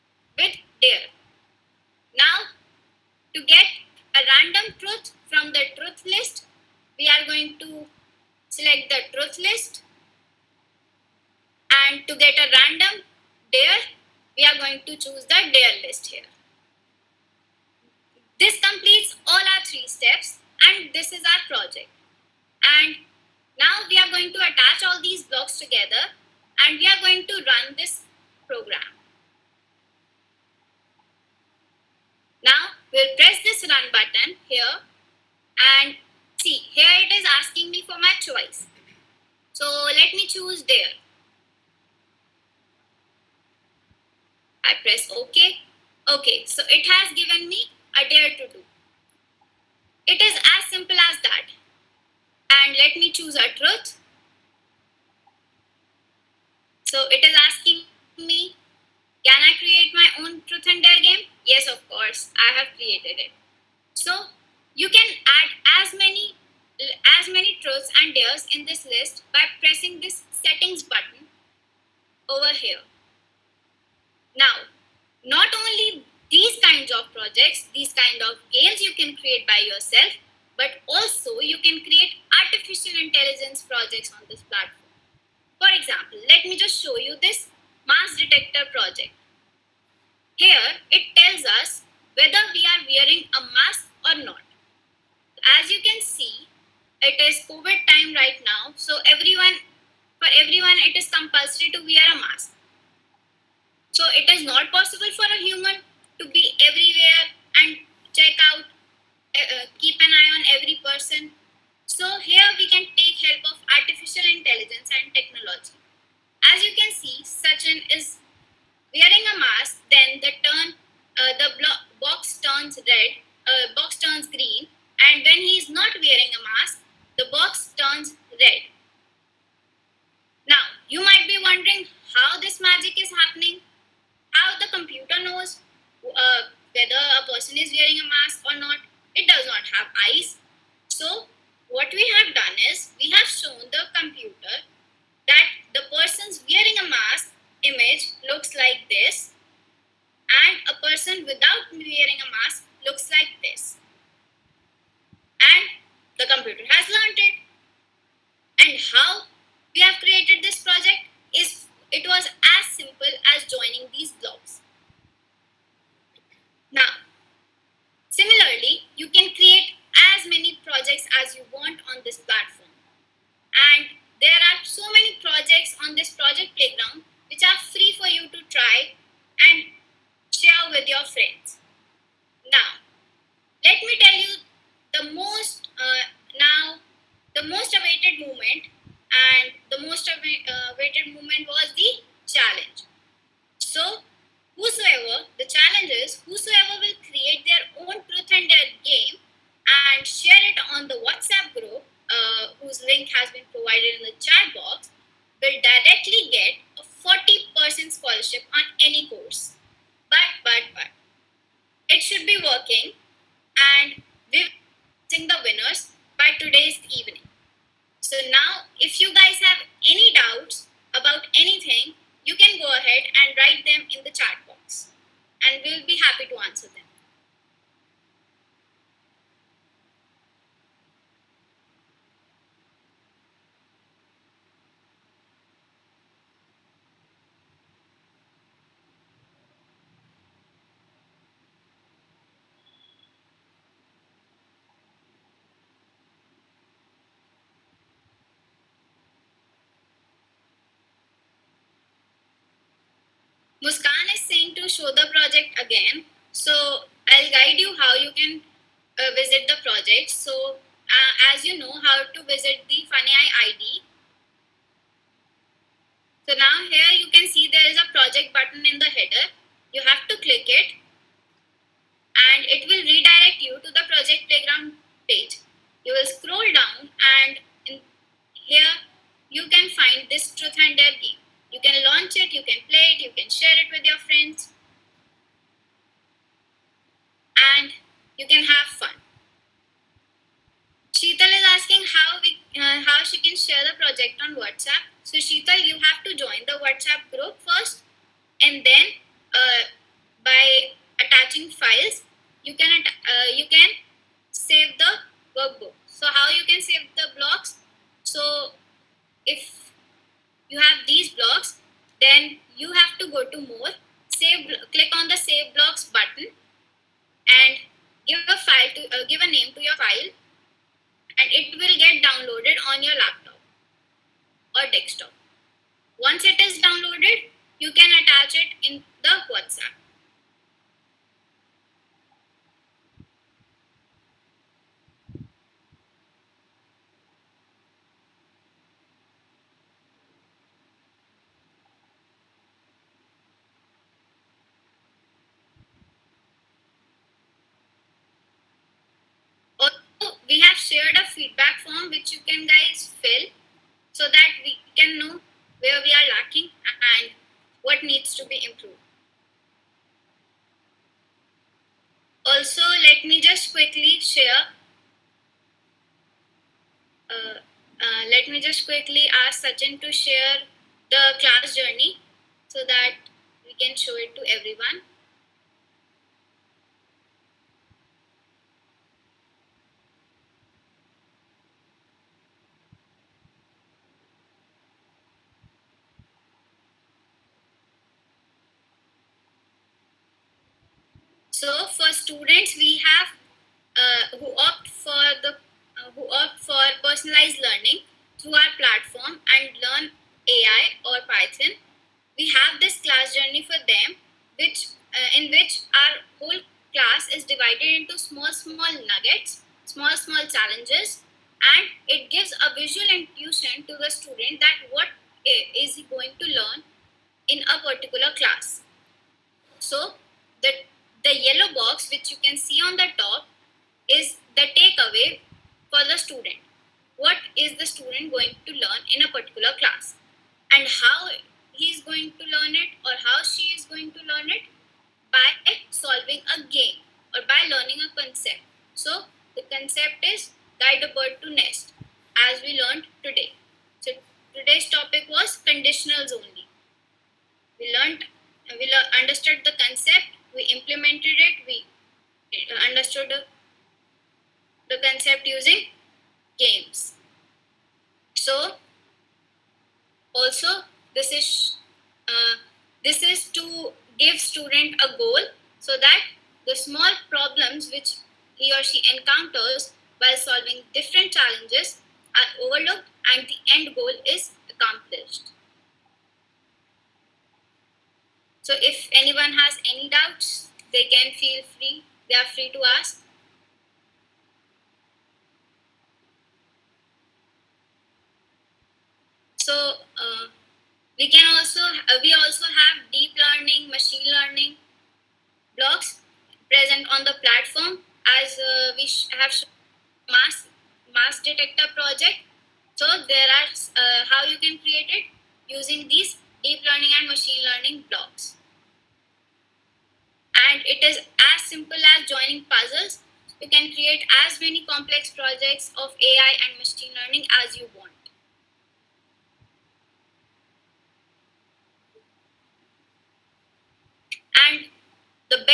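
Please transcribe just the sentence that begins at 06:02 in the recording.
Also, let me just quickly share.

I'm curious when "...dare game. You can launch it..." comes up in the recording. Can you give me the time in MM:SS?
04:40.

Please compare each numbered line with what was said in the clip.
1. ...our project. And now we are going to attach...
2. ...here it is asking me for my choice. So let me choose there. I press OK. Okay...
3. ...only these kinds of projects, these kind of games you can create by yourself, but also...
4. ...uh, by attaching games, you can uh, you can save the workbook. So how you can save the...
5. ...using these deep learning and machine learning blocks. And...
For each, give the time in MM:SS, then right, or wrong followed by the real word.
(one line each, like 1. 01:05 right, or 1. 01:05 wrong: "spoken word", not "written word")
1. 00:21 right
2. 00:36 right
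3. 01:15 right
4. 04:59 wrong: "files", not "games"
5. 08:25 right.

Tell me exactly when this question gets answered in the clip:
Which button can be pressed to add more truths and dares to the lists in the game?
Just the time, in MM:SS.
01:10.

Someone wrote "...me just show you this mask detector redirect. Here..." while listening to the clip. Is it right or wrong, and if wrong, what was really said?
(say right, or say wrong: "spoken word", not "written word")
wrong: "project", not "redirect".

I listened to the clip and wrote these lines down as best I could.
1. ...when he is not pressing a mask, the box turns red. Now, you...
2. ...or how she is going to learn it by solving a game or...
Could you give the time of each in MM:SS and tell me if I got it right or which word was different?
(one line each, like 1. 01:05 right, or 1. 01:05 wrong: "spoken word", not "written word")
1. 02:05 wrong: "wearing", not "pressing"
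2. 07:12 right.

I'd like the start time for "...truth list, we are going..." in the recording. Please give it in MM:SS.
00:05.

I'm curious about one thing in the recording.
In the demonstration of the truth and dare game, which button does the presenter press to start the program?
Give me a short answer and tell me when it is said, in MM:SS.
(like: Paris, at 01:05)
Run button, at 00:33.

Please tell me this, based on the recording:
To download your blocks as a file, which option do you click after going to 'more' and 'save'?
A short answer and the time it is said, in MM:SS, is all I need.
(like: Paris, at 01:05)
Save blocks, at 05:15.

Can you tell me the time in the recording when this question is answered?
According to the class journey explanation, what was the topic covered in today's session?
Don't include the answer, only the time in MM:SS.
07:25.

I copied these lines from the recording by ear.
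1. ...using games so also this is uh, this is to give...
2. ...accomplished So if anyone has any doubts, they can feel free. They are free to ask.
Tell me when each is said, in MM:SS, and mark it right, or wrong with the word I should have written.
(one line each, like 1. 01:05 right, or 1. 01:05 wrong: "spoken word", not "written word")
1. 07:35 right
2. 07:54 right.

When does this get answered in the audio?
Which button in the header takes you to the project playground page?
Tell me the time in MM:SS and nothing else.
04:27.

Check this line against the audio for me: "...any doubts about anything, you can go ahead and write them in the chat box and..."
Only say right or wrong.
right.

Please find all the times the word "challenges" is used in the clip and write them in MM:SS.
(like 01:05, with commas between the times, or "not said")
06:50, 07:51.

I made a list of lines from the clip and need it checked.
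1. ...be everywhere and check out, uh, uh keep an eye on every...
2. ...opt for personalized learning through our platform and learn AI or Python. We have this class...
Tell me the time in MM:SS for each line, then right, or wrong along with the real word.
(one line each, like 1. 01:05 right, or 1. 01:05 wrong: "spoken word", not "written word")
1. 01:46 right
2. 06:36 right.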